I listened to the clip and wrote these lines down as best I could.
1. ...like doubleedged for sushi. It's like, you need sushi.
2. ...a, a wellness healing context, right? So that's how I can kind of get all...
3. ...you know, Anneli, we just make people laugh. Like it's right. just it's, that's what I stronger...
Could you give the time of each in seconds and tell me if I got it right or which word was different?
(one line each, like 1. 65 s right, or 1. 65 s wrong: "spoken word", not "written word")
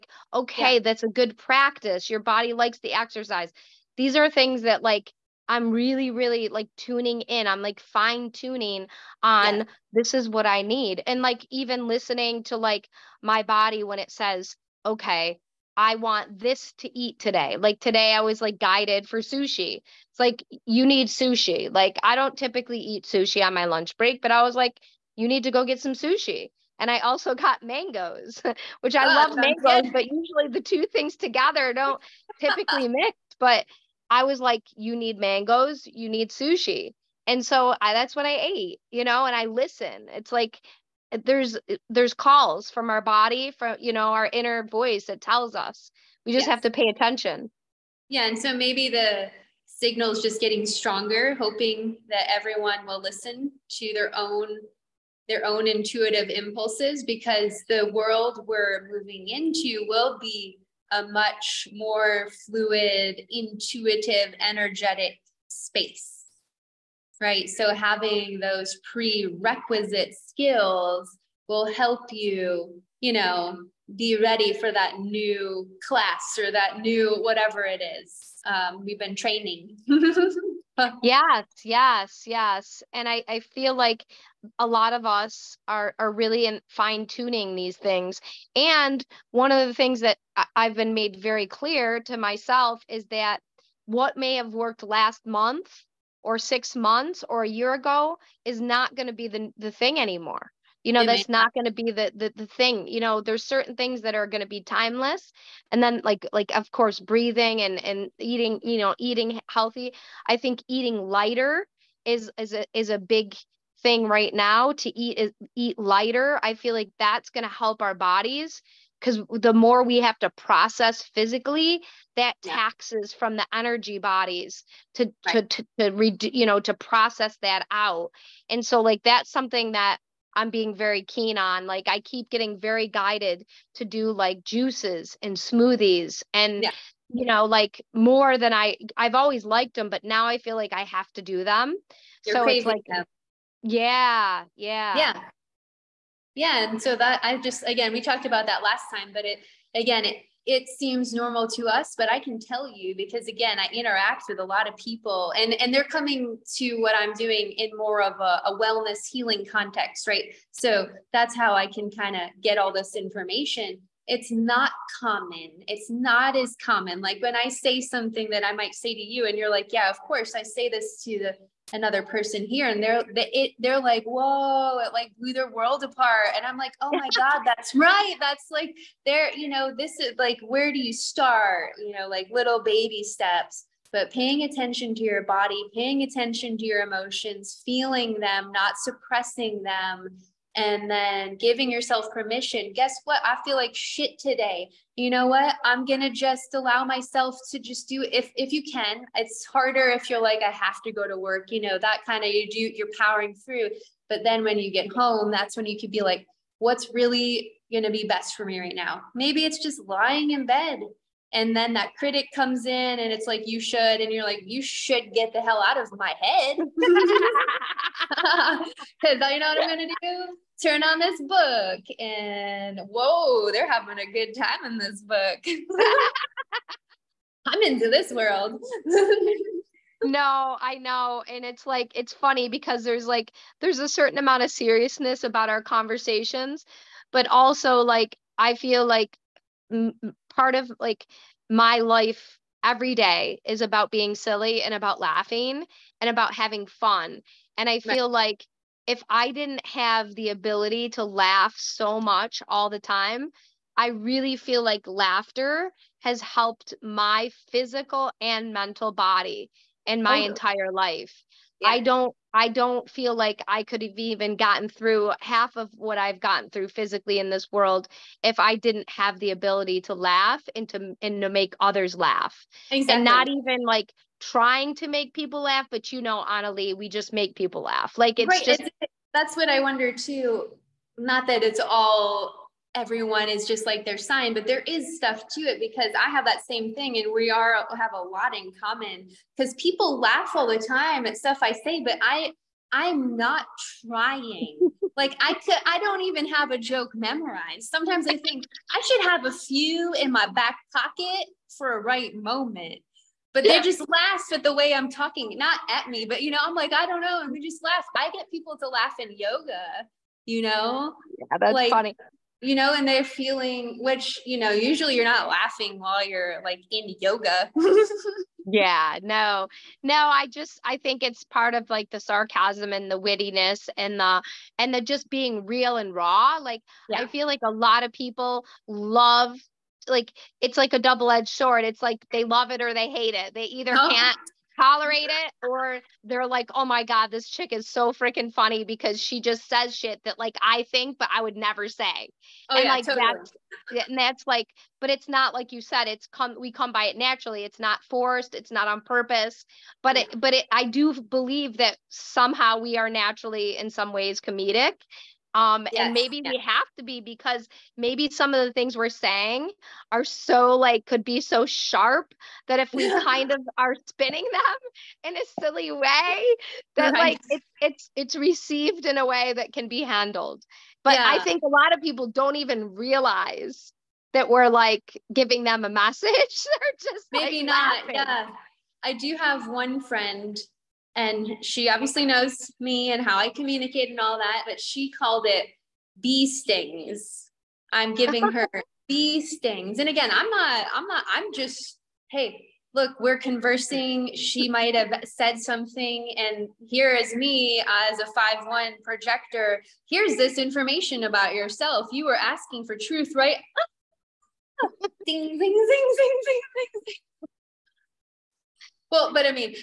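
1. 18 s wrong: "guided", not "doubleedged"
2. 158 s right
3. 275 s wrong: "wonder", not "stronger".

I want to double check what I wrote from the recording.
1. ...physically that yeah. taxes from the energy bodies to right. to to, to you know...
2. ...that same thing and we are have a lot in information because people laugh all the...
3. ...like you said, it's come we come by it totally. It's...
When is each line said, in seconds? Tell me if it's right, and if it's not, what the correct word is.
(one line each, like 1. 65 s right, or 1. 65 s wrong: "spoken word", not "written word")
1. 121 s right
2. 286 s wrong: "common", not "information"
3. 345 s wrong: "naturally", not "totally".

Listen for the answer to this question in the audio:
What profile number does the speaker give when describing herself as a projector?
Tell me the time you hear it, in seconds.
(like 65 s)
398 s.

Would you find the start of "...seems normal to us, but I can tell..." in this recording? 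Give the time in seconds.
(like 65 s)
150 s.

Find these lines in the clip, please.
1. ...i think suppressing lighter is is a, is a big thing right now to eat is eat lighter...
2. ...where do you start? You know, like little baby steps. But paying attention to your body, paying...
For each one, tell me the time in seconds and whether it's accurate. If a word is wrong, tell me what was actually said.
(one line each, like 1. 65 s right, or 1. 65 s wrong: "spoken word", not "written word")
1. 110 s wrong: "eating", not "suppressing"
2. 180 s right.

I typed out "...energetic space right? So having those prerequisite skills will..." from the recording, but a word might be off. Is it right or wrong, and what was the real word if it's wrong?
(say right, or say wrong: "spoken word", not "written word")
right.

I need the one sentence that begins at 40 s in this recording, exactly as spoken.
It's like Eh, there's eh, there's calls from our body from you know our inner voice that tells us we just yes.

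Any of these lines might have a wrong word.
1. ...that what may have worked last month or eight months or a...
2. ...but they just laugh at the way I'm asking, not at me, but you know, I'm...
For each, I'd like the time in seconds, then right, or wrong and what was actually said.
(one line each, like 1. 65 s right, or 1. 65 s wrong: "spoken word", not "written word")
1. 93 s wrong: "six", not "eight"
2. 303 s wrong: "talking", not "asking".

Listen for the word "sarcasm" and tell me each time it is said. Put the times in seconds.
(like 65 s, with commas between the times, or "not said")
322 s.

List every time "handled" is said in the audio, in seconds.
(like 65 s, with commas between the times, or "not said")
369 s.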